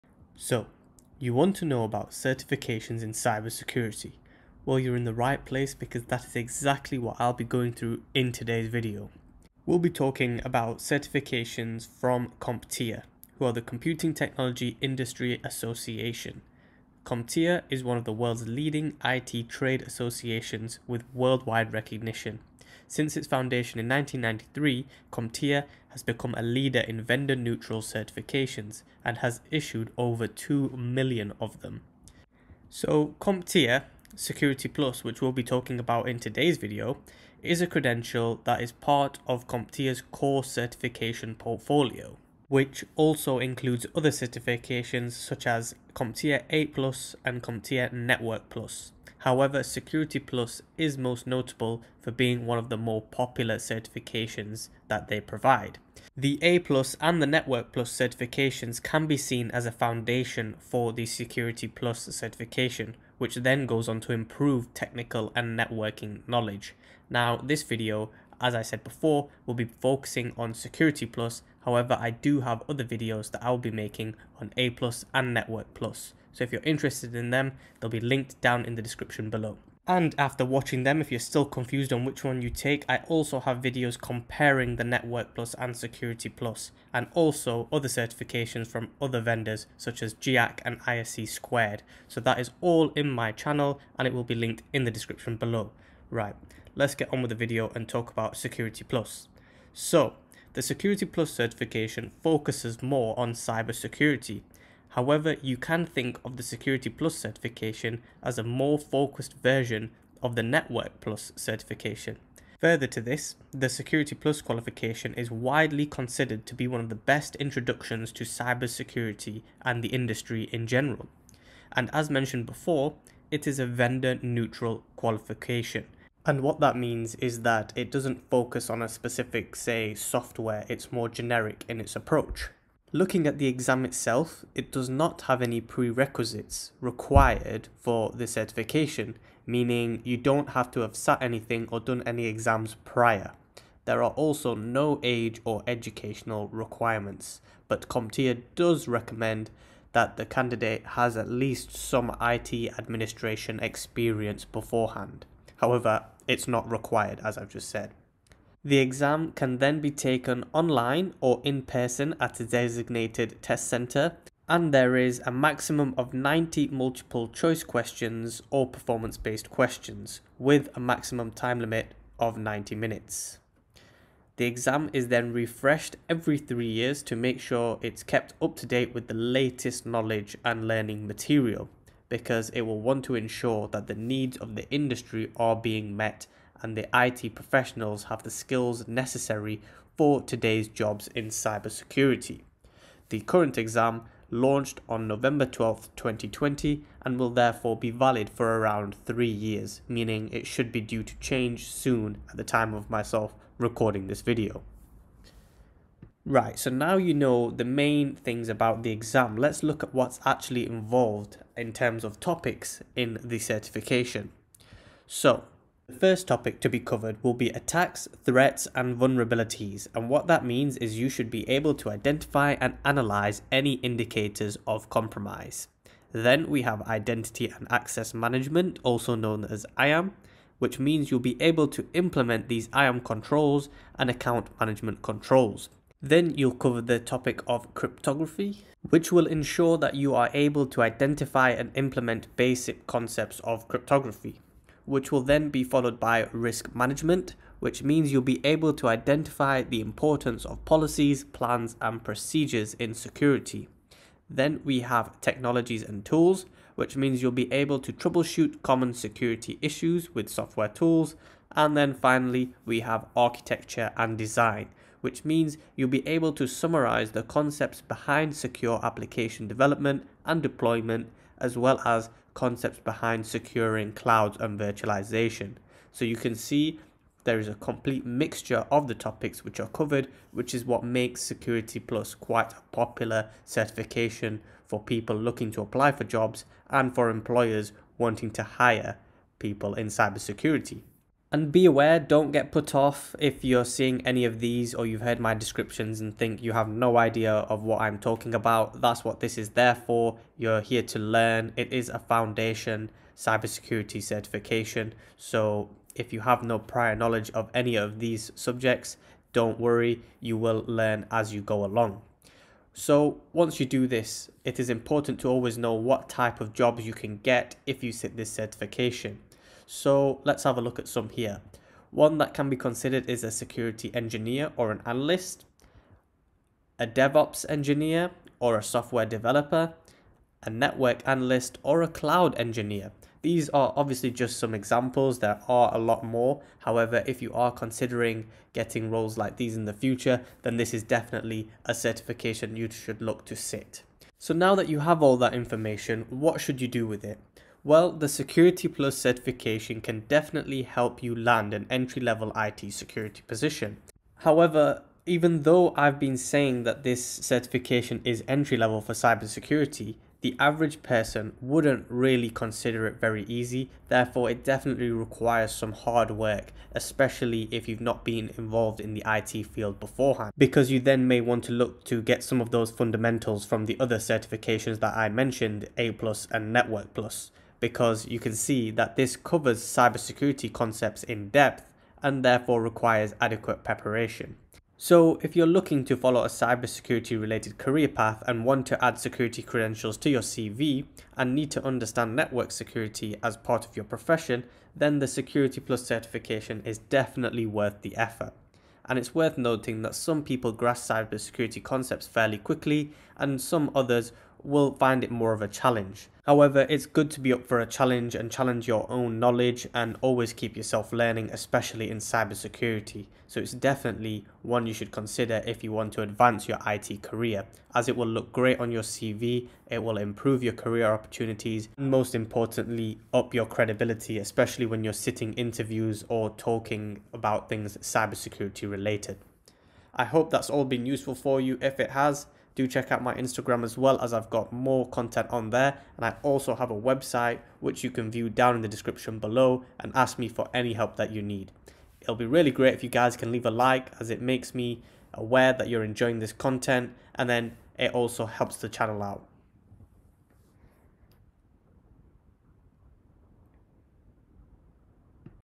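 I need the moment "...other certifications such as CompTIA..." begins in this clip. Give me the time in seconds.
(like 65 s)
43 s.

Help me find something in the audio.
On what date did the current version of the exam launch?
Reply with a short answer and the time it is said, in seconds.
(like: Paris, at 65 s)
November 12, 2020, at 195 s.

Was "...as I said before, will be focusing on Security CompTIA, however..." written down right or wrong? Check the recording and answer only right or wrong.
wrong.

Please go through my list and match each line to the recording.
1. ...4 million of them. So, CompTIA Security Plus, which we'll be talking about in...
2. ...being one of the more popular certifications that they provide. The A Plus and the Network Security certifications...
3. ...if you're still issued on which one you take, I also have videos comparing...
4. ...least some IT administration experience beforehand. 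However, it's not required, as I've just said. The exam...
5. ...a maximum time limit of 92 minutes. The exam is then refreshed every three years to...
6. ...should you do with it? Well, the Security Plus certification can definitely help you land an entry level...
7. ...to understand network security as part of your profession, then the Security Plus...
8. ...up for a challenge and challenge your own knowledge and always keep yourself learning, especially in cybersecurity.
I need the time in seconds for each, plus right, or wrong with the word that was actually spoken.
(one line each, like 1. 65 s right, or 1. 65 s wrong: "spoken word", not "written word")
1. 30 s wrong: "2", not "4"
2. 52 s wrong: "Plus", not "Security"
3. 81 s wrong: "confused", not "issued"
4. 151 s right
5. 170 s wrong: "90", not "92"
6. 346 s right
7. 391 s right
8. 407 s right.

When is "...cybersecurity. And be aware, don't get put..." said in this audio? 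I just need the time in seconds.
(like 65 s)
289 s.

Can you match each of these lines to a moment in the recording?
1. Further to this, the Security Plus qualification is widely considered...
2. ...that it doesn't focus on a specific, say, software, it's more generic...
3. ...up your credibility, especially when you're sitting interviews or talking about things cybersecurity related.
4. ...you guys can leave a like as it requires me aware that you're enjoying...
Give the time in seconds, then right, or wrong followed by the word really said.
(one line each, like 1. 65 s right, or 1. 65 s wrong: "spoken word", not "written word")
1. 112 s right
2. 127 s right
3. 423 s right
4. 442 s wrong: "makes", not "requires".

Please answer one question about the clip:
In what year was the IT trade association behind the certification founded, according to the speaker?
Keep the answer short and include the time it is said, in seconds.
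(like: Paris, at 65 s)
1993, at 23 s.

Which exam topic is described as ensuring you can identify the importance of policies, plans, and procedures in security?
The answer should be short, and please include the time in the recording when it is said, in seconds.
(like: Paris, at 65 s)
risk management, at 246 s.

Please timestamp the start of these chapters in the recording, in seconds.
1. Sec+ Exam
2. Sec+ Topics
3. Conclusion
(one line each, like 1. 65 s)
1. 99 s
2. 215 s
3. 345 s.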